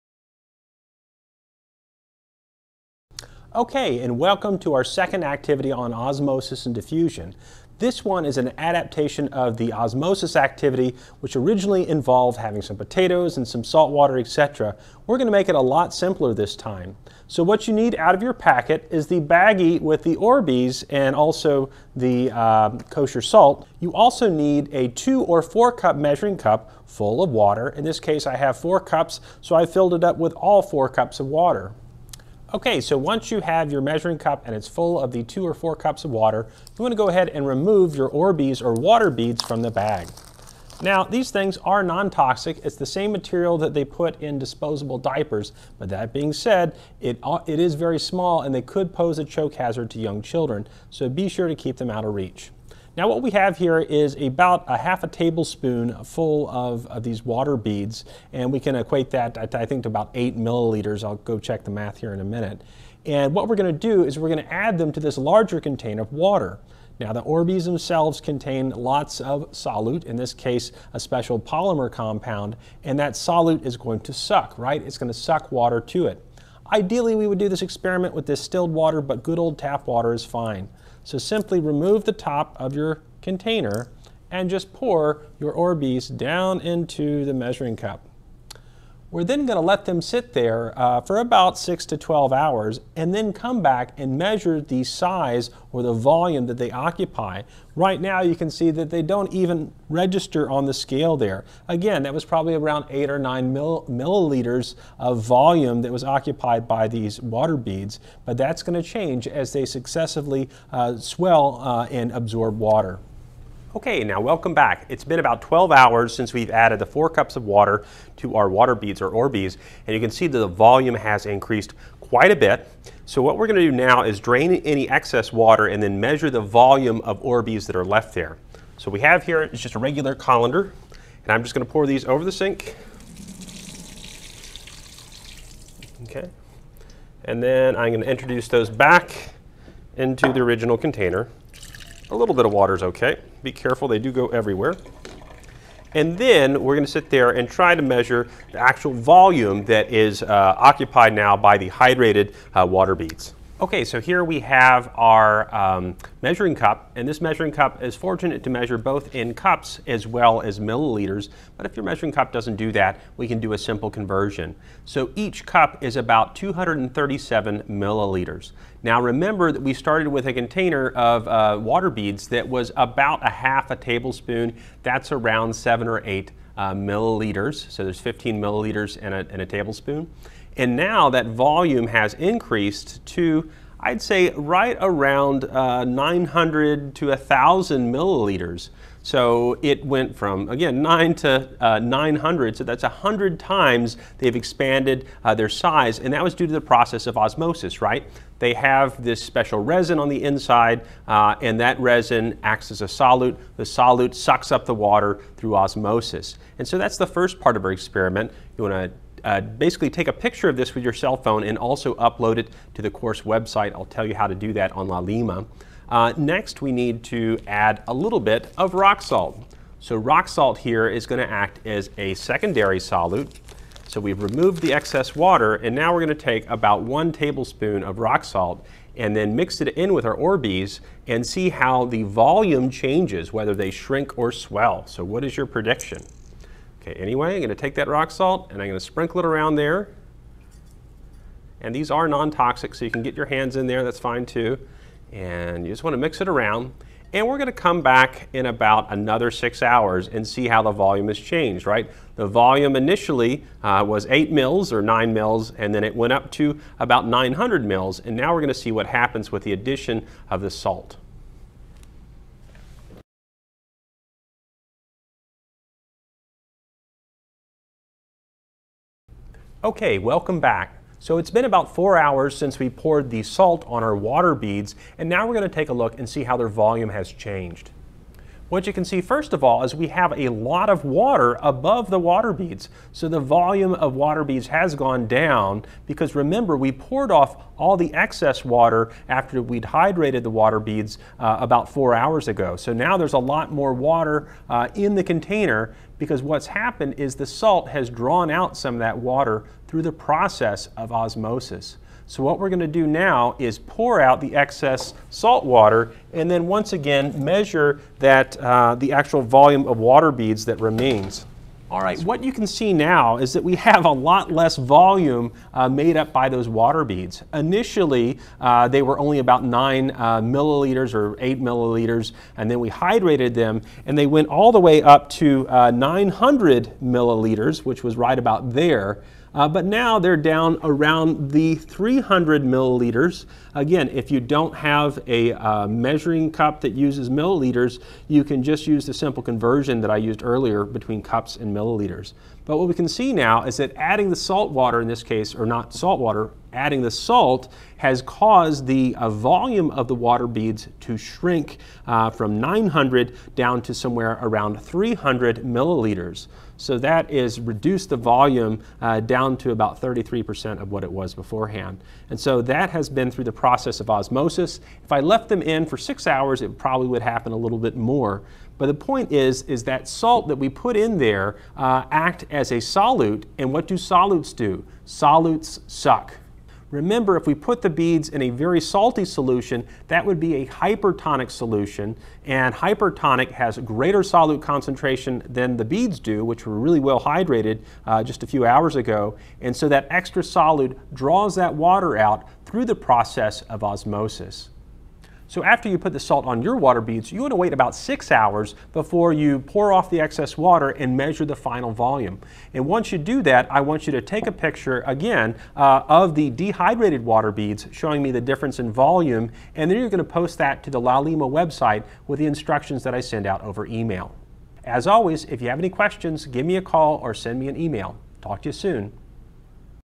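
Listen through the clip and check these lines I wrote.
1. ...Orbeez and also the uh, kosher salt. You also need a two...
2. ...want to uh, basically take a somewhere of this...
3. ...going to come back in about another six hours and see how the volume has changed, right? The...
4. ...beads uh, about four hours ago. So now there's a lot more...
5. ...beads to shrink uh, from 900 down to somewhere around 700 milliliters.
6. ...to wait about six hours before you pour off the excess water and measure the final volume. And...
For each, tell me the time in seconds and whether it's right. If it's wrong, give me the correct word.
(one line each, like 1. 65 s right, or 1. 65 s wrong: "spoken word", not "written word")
1. 20 s right
2. 208 s wrong: "picture", not "somewhere"
3. 247 s right
4. 290 s right
5. 350 s wrong: "300", not "700"
6. 397 s right.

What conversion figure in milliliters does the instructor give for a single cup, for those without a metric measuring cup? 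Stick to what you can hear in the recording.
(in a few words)
237.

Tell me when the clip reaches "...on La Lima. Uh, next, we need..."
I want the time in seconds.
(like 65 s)
214 s.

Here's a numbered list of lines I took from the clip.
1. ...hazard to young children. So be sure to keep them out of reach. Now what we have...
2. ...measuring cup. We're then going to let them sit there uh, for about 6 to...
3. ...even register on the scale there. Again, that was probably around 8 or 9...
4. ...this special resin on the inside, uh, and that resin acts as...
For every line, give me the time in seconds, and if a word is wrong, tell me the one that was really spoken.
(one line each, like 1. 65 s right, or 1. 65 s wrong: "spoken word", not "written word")
1. 49 s right
2. 87 s right
3. 99 s right
4. 199 s right.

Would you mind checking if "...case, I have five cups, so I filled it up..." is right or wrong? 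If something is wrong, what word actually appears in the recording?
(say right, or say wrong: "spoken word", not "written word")
wrong: "four", not "five".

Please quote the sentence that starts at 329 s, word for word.
Uh, but now they're down around the 300 milliliters.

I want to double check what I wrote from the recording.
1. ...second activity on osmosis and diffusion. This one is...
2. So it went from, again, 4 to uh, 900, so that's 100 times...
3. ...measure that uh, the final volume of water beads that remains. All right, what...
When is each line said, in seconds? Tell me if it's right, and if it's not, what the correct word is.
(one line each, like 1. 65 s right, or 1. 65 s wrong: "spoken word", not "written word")
1. 4 s right
2. 189 s wrong: "9", not "4"
3. 307 s wrong: "actual", not "final".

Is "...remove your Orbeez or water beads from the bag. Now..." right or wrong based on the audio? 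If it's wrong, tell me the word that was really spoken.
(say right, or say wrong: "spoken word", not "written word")
right.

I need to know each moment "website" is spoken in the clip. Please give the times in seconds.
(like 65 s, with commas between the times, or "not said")
213 s, 411 s.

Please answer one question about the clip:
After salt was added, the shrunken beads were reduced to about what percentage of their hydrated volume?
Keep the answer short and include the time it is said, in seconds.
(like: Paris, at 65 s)
33%, at 359 s.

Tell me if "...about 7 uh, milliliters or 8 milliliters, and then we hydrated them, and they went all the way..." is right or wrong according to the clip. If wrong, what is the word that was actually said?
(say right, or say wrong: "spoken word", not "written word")
wrong: "9", not "7".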